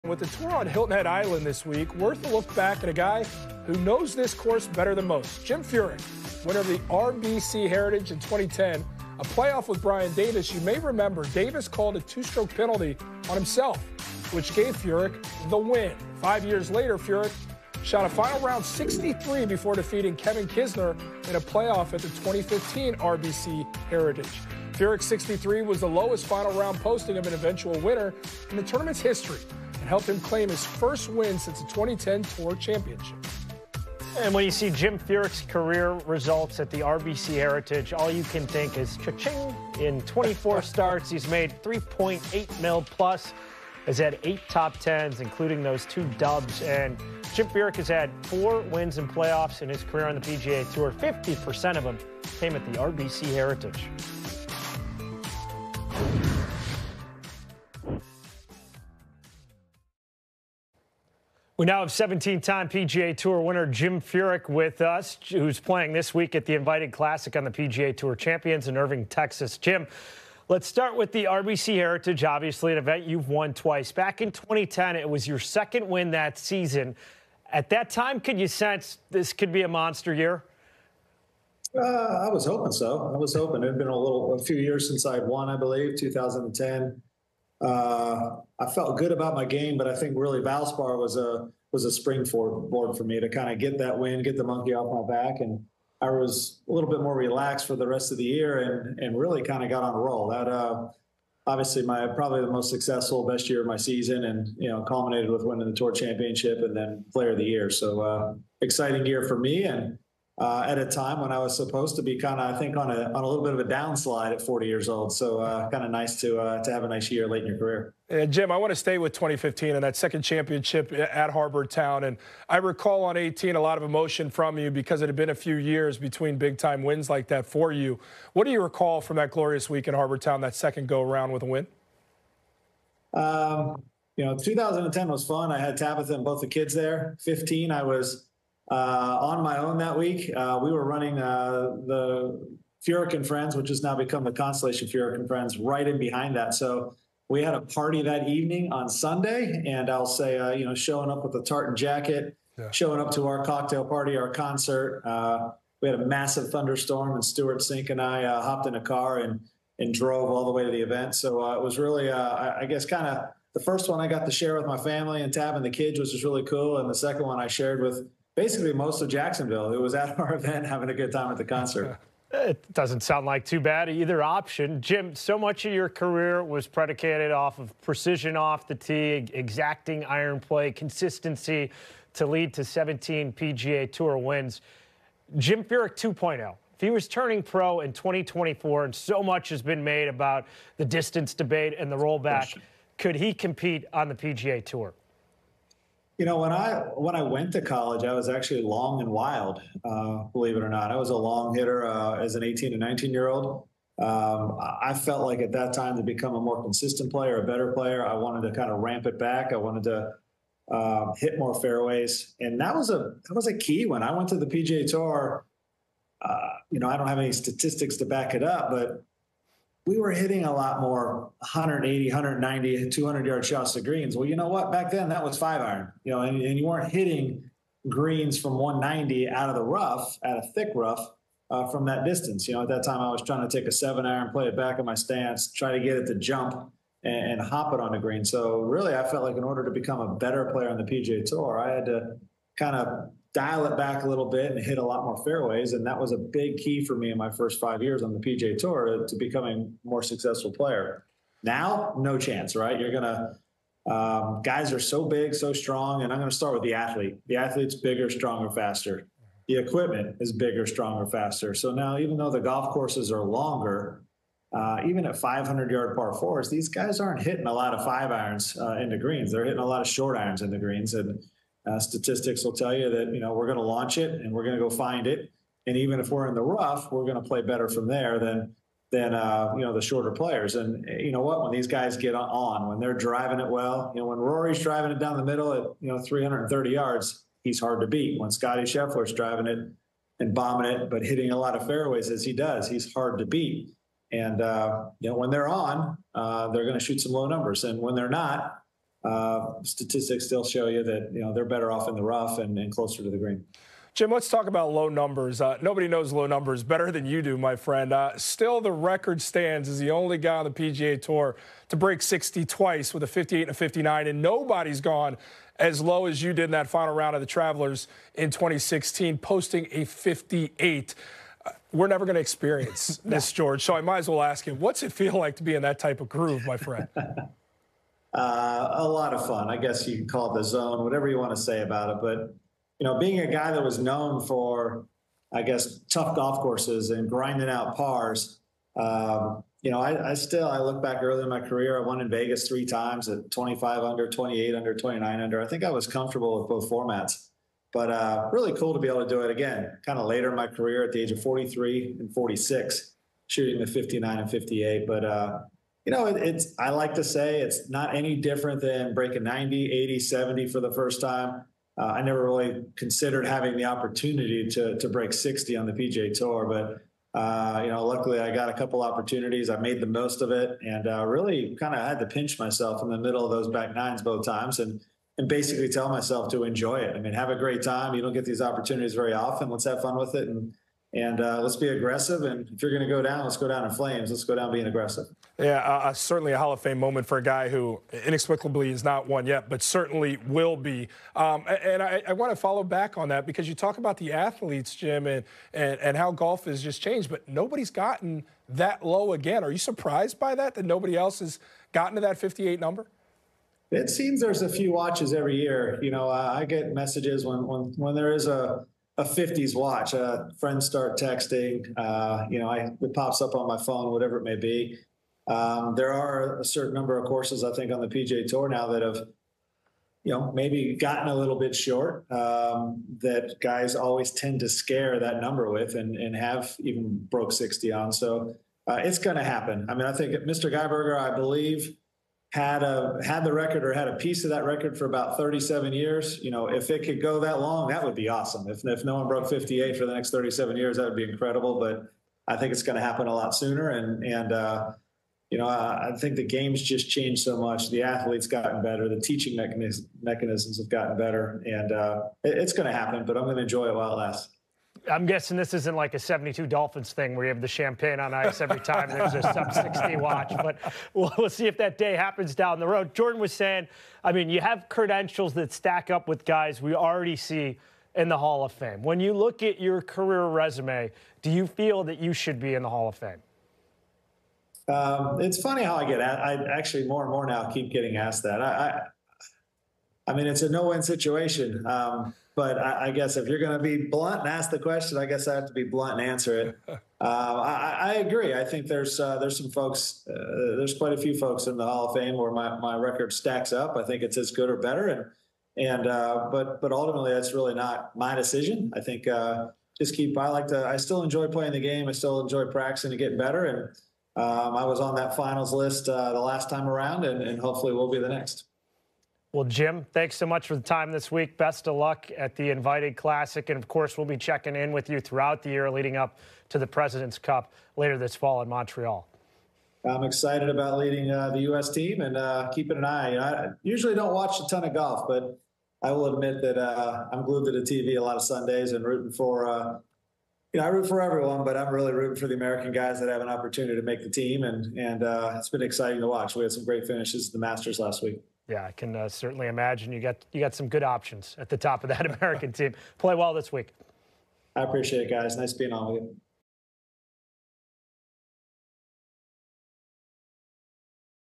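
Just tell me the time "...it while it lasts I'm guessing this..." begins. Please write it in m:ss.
7:33.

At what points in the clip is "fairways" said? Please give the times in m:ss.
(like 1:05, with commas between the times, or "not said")
3:31, 4:05, 4:51.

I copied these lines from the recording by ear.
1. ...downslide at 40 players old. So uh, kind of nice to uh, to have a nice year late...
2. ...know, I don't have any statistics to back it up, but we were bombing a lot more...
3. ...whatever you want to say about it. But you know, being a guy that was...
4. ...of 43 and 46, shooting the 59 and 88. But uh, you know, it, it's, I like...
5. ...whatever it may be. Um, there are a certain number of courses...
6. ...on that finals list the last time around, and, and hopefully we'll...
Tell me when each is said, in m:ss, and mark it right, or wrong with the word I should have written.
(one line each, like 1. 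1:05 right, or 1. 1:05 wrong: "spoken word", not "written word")
1. 1:53 wrong: "years", not "players"
2. 3:36 wrong: "hitting", not "bombing"
3. 5:30 right
4. 5:51 wrong: "58", not "88"
5. 6:53 right
6. 8:24 right.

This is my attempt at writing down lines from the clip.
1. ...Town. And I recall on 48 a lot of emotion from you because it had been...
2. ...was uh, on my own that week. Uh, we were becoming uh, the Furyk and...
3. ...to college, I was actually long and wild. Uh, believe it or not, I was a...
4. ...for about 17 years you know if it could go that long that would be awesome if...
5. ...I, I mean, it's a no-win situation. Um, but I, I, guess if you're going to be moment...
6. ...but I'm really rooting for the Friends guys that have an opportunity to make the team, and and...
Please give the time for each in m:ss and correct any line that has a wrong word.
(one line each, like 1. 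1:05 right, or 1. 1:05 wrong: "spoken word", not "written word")
1. 2:01 wrong: "18", not "48"
2. 2:17 wrong: "running", not "becoming"
3. 3:17 right
4. 7:14 wrong: "37", not "17"
5. 8:00 wrong: "blunt", not "moment"
6. 8:51 wrong: "American", not "Friends".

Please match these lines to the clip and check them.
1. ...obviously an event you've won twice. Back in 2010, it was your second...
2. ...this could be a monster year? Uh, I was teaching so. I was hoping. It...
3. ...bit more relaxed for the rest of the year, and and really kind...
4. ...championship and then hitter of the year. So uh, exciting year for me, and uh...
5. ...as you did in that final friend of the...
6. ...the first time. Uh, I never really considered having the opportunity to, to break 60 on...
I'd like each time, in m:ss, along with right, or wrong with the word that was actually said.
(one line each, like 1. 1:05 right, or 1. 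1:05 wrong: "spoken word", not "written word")
1. 1:12 right
2. 1:19 wrong: "hoping", not "teaching"
3. 1:36 right
4. 1:45 wrong: "player", not "hitter"
5. 5:16 wrong: "round", not "friend"
6. 6:00 right.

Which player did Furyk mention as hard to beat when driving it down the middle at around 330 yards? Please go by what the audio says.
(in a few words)
Rory.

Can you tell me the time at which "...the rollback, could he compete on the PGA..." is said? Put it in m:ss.
3:11.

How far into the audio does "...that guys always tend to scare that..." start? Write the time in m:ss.
7:02.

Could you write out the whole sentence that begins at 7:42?
Jordan was saying, I mean, you have credentials that stack up with guys we already see in the Hall of Fame.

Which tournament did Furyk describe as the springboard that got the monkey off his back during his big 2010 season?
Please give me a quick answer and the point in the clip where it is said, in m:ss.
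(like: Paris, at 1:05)
Valspar, at 1:30.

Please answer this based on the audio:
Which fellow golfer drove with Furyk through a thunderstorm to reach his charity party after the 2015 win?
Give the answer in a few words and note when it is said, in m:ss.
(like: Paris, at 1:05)
Stewart Cink, at 2:37.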